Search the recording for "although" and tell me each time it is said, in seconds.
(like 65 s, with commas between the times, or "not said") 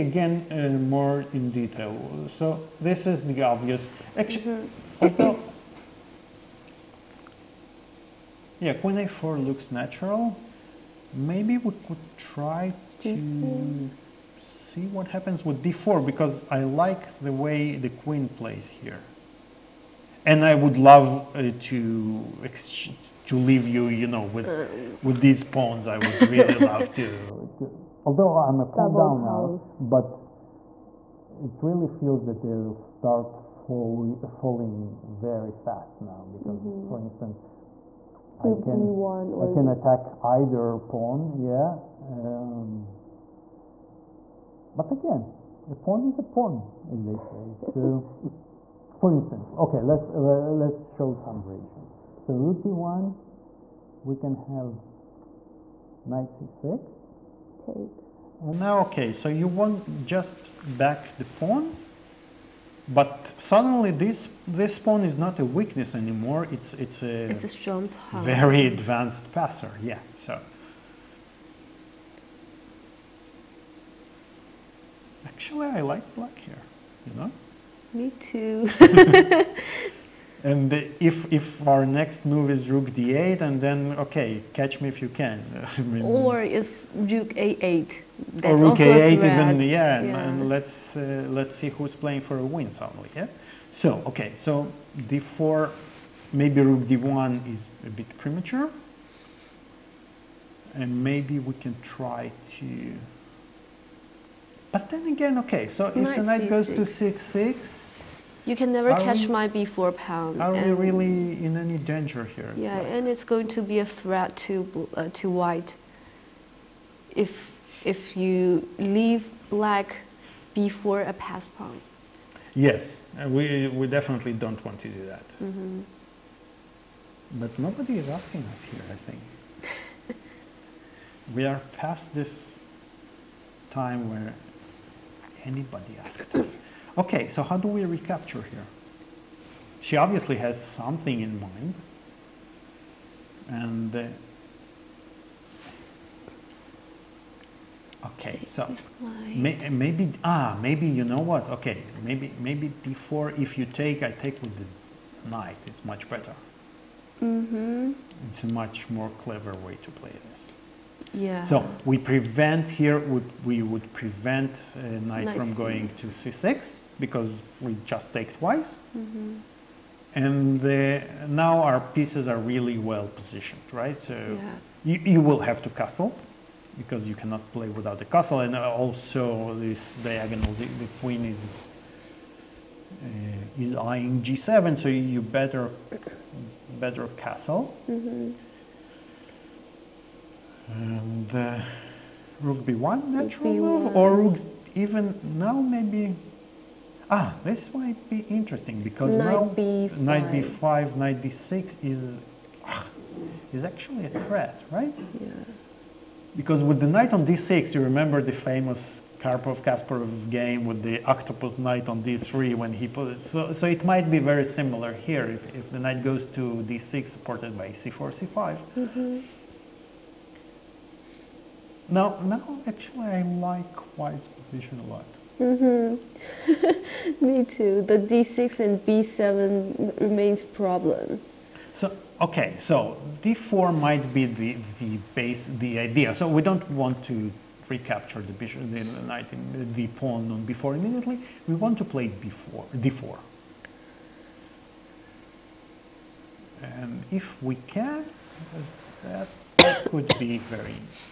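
5 s, 28 s.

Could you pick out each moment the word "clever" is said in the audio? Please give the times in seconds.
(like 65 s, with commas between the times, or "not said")
159 s.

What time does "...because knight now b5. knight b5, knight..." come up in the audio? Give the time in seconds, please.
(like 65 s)
198 s.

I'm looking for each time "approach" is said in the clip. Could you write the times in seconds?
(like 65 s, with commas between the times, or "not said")
not said.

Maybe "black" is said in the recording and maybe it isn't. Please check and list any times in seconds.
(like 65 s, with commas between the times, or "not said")
76 s, 119 s.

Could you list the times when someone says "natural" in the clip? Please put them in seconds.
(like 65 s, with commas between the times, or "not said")
9 s, 193 s.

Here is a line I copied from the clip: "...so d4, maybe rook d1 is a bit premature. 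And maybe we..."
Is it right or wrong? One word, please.
right.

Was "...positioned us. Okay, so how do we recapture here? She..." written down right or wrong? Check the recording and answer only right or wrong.
wrong.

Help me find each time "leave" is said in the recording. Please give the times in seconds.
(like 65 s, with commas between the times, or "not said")
23 s, 118 s.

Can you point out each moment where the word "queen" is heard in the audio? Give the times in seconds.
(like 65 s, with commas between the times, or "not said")
8 s, 17 s, 181 s.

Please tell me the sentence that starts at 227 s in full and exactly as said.
The d6 and b7 remains problem.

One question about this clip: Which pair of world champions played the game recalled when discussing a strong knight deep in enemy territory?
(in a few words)
Karpov-Kasparov.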